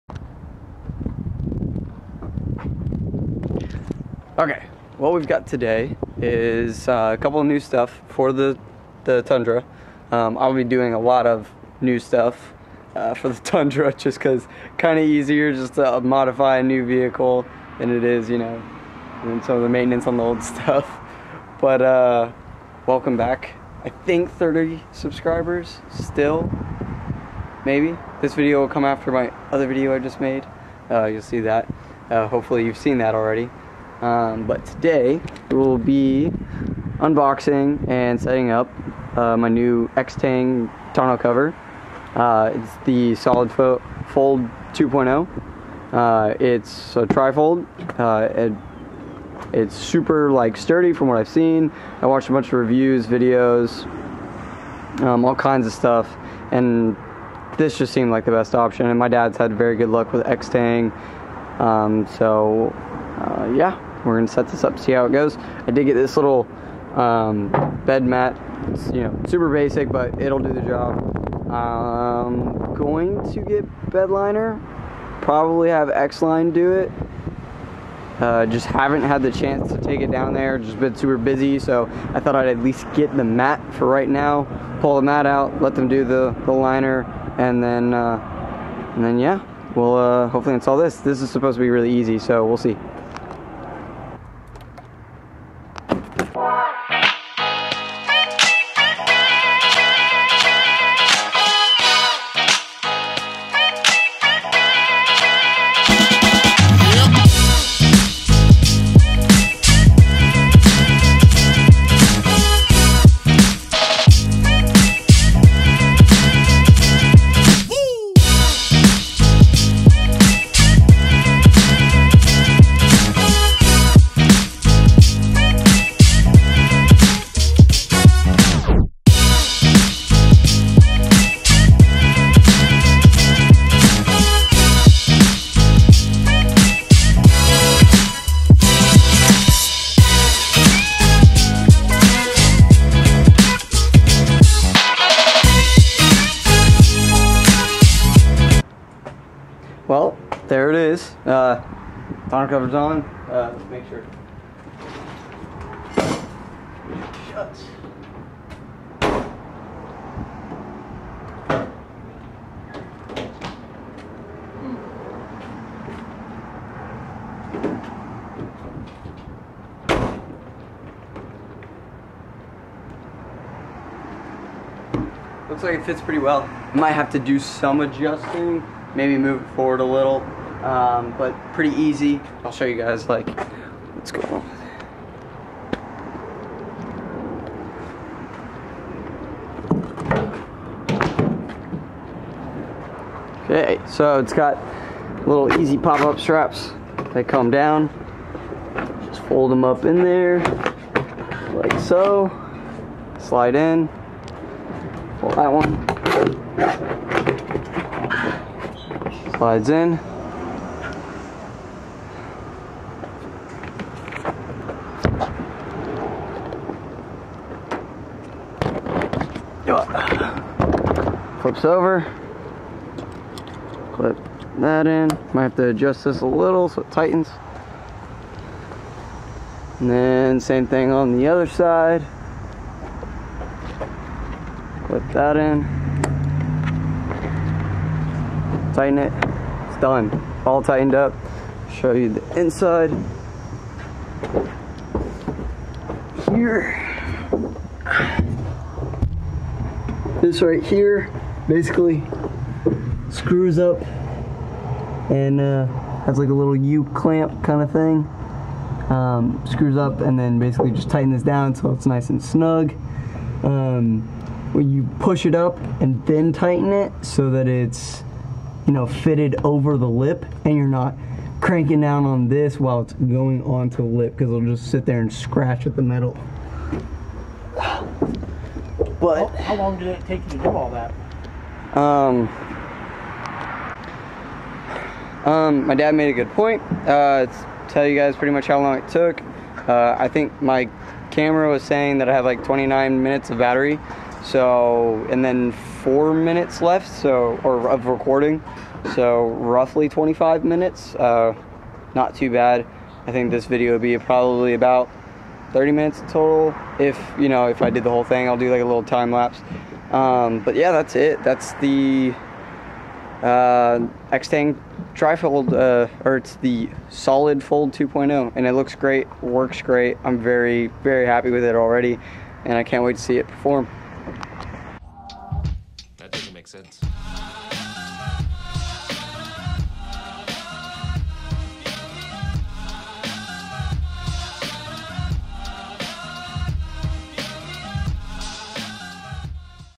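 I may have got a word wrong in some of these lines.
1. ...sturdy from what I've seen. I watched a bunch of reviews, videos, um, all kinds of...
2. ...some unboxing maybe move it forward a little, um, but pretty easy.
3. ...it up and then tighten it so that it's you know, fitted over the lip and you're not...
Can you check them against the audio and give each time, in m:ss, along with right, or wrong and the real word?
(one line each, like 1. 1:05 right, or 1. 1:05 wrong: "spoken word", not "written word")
1. 0:50 right
2. 2:57 wrong: "adjusting", not "unboxing"
3. 4:25 right.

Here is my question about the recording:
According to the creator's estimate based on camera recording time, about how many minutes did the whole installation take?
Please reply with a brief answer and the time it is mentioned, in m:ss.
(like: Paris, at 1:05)
25, at 4:59.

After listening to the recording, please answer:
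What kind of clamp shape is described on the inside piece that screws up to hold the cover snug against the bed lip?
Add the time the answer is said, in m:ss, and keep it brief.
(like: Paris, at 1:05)
U clamp, at 4:16.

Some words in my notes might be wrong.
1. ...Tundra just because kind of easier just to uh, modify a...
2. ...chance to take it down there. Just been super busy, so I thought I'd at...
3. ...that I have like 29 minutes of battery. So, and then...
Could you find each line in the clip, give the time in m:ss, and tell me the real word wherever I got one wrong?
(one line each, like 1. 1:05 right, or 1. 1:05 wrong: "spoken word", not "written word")
1. 0:13 right
2. 1:19 right
3. 4:51 right.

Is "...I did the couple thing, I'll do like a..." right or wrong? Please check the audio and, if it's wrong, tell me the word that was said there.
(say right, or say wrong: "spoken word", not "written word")
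wrong: "whole", not "couple".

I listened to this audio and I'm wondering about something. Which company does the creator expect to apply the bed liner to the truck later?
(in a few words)
X line.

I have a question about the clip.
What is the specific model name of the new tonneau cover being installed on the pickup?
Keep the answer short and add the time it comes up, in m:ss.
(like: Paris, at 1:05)
Solid Fold 2.0, at 0:43.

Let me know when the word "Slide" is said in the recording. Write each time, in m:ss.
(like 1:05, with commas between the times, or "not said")
3:23, 3:29.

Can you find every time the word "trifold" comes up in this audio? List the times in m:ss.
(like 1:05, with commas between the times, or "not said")
0:47, 5:14.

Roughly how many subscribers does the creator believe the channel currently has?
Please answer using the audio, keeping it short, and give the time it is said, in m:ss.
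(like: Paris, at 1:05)
30, at 0:24.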